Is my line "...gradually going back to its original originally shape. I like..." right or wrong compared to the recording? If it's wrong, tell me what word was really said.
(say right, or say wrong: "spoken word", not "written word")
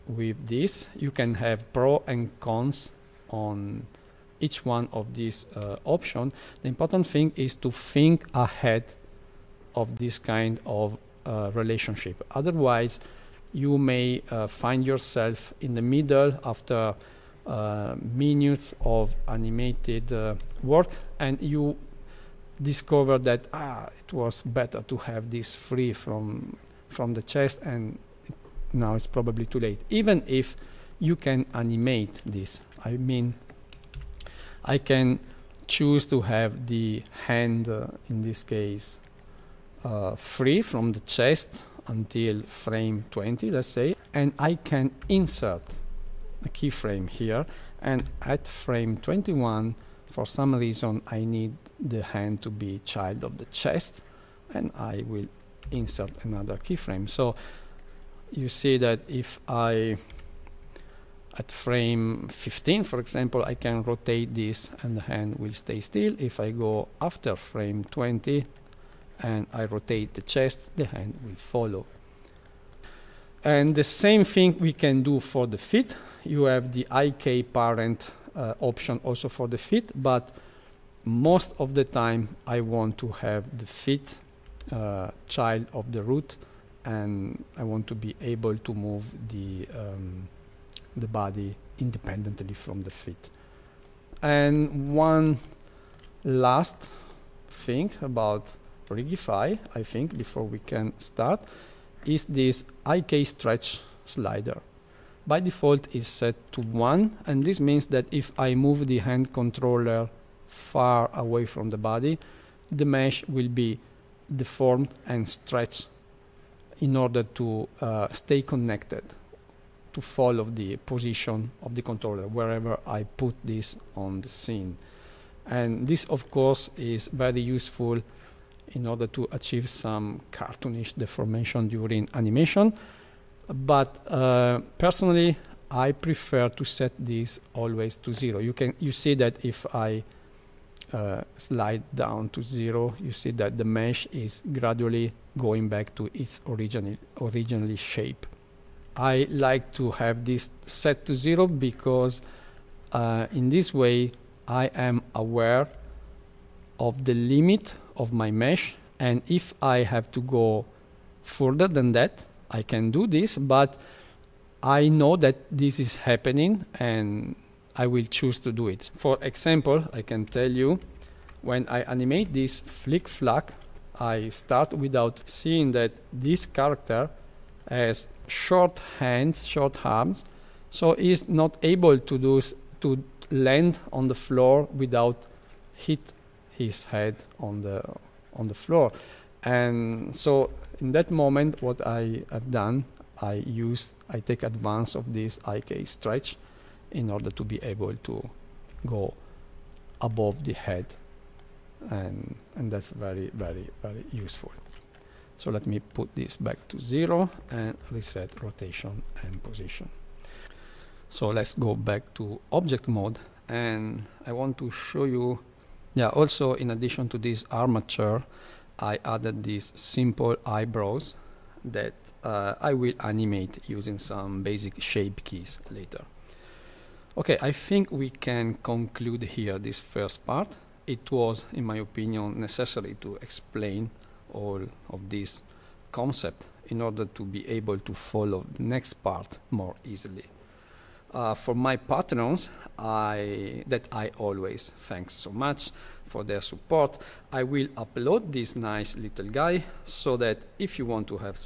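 right.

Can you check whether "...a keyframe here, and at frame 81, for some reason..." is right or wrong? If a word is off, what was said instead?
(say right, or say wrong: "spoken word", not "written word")
wrong: "21", not "81".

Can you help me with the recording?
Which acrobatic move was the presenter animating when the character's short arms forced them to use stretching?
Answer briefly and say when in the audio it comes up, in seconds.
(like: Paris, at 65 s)
flick flack, at 172 s.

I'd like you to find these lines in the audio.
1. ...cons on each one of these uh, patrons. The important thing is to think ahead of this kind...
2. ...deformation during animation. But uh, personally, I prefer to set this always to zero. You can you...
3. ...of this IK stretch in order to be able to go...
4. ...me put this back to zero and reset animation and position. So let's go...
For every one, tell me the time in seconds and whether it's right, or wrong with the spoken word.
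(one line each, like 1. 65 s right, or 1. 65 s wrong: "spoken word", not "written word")
1. 2 s wrong: "options", not "patrons"
2. 130 s right
3. 194 s right
4. 205 s wrong: "rotation", not "animation".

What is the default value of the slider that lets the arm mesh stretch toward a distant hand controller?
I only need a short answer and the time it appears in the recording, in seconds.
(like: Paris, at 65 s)
1, at 106 s.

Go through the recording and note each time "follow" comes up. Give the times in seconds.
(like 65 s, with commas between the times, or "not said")
71 s, 120 s, 237 s.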